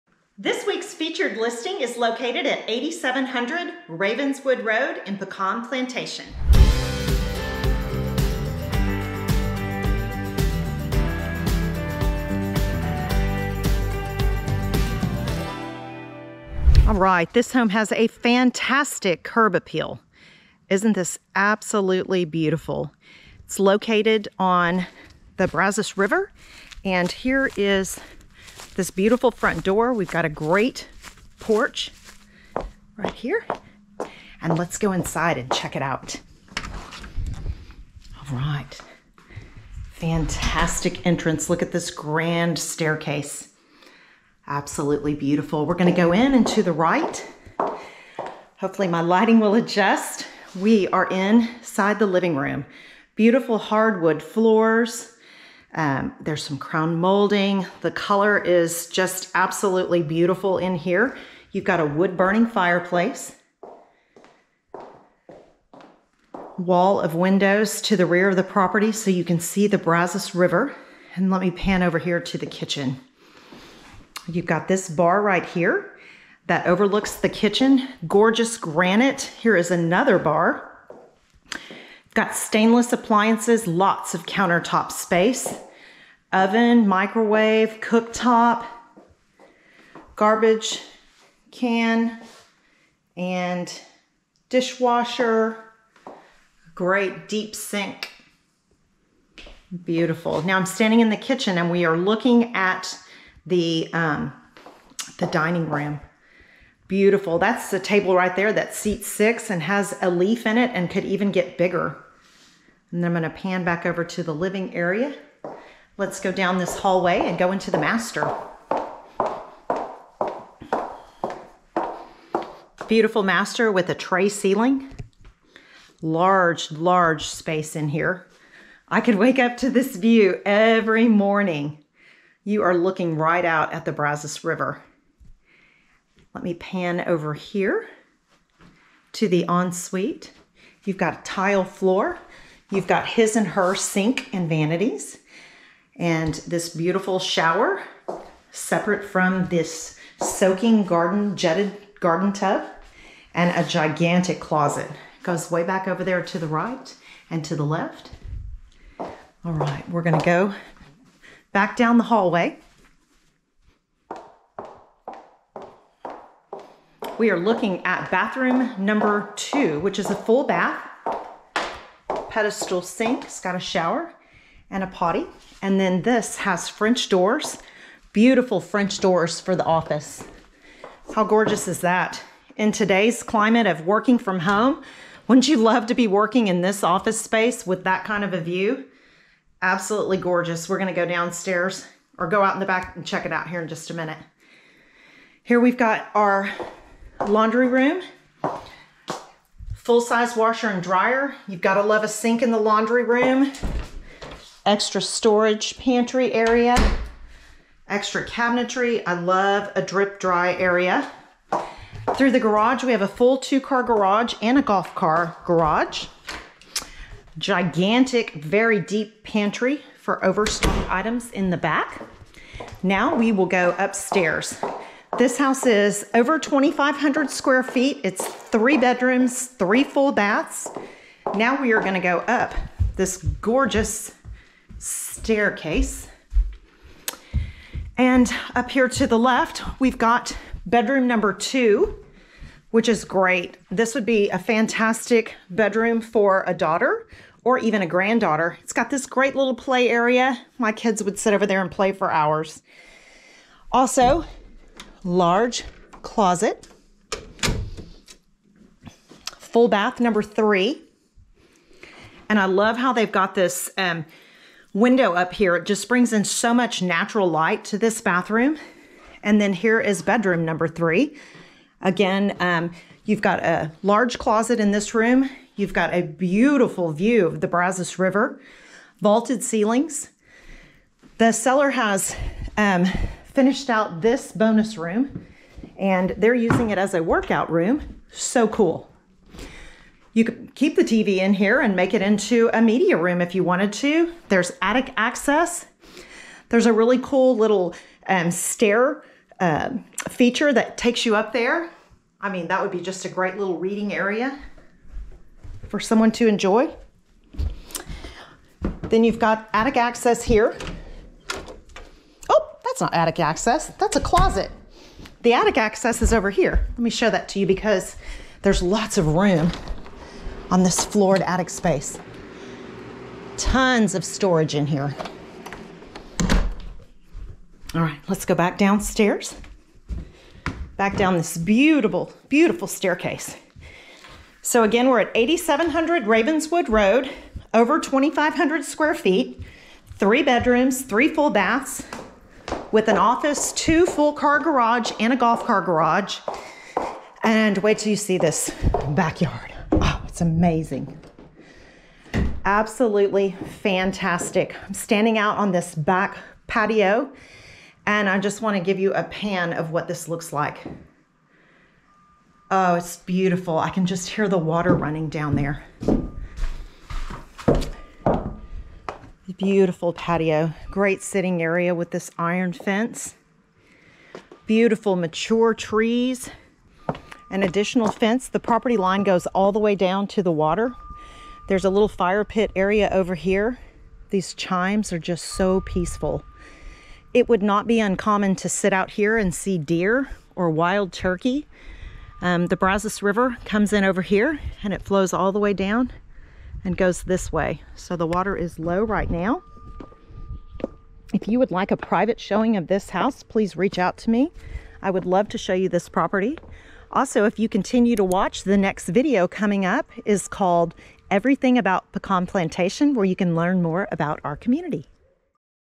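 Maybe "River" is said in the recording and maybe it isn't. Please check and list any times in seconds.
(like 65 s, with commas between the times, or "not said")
25 s, 70 s, 134 s, 277 s, 393 s.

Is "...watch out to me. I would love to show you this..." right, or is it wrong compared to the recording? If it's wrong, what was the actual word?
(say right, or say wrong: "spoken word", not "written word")
wrong: "reach", not "watch".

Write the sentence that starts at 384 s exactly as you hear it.
These chimes are just so peaceful.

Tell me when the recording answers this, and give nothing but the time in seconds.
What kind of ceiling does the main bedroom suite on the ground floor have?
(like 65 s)
123 s.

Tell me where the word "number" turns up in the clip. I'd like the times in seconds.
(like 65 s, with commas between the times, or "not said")
168 s, 241 s, 259 s, 270 s.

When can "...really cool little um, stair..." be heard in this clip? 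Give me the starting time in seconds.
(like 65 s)
296 s.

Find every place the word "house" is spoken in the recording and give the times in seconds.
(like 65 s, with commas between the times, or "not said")
225 s, 402 s.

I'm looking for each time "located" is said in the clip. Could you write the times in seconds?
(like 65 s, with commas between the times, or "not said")
1 s, 23 s.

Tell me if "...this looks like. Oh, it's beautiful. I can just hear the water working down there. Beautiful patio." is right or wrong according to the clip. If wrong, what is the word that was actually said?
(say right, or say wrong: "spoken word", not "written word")
wrong: "running", not "working".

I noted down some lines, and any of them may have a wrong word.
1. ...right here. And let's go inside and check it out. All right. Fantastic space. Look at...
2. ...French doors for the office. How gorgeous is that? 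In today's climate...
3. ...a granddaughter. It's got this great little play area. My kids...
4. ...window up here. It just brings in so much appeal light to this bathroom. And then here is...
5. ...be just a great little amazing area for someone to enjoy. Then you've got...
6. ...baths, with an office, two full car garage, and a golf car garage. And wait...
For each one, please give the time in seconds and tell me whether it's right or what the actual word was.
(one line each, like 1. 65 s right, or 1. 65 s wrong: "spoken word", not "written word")
1. 32 s wrong: "entrance", not "space"
2. 178 s right
3. 247 s right
4. 264 s wrong: "natural", not "appeal"
5. 302 s wrong: "reading", not "amazing"
6. 341 s right.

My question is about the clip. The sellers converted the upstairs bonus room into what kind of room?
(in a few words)
Workout room.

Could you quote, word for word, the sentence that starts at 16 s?
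All right, this home has a fantastic curb appeal.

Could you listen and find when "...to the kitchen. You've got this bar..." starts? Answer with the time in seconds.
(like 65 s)
72 s.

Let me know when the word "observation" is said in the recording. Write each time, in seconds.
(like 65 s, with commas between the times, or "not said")
not said.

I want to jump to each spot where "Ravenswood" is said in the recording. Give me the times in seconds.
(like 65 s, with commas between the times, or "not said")
3 s, 336 s.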